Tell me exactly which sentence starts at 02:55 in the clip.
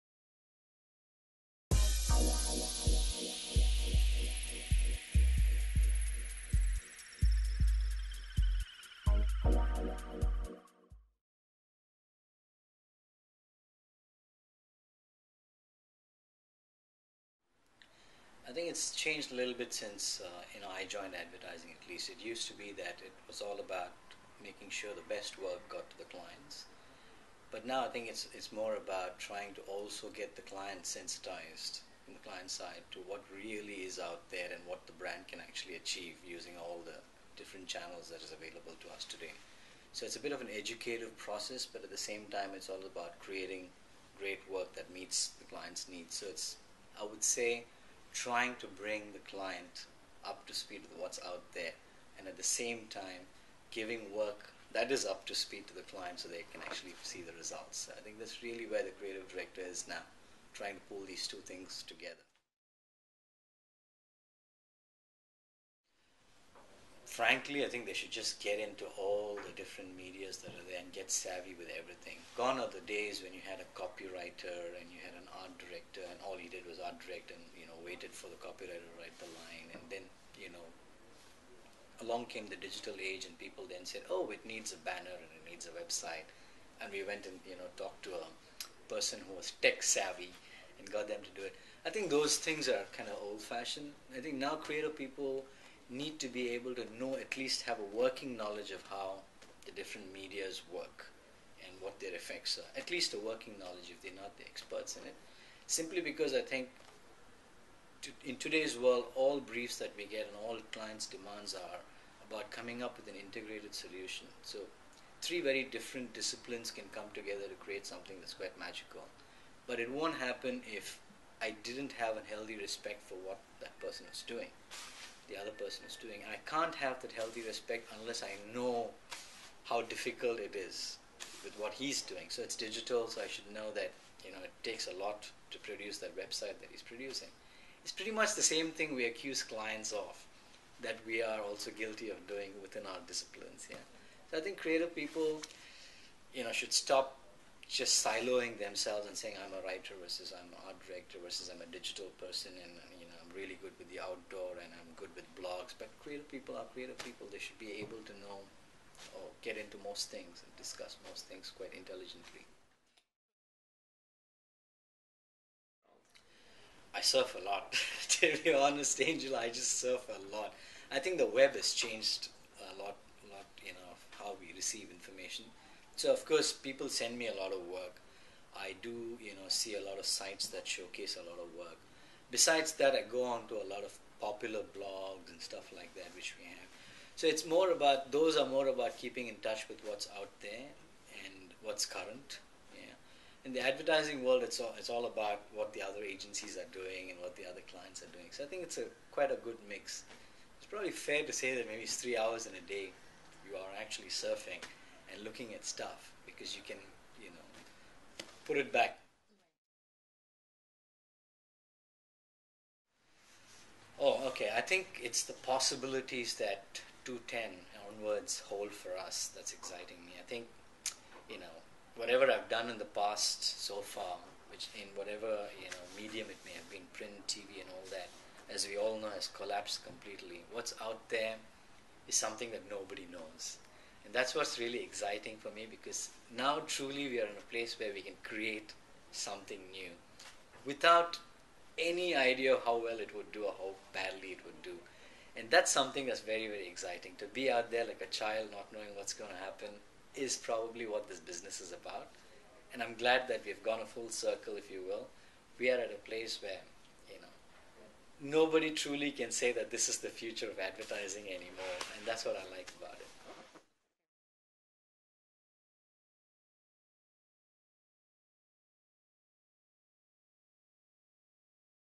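So of course, people send me a lot of work.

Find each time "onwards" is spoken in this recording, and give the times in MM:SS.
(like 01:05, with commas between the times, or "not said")
03:37.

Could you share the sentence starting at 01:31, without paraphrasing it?
I think those things are kind of old fashioned.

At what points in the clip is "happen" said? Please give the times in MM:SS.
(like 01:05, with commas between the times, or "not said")
02:00, 04:09.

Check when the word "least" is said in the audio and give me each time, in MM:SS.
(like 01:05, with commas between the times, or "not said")
00:21, 01:37, 01:42.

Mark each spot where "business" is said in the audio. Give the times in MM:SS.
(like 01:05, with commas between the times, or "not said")
04:11.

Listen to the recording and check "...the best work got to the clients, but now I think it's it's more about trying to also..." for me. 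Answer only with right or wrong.
right.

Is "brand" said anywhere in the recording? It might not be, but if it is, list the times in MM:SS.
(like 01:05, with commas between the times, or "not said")
00:34.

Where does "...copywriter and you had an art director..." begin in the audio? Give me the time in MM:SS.
01:13.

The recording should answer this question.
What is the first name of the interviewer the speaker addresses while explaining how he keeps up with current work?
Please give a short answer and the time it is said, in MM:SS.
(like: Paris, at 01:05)
Angel, at 02:49.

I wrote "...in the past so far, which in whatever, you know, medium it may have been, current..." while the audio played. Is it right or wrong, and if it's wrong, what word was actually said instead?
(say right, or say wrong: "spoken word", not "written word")
wrong: "print", not "current".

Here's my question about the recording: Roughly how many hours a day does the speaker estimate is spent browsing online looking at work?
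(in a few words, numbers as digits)
3.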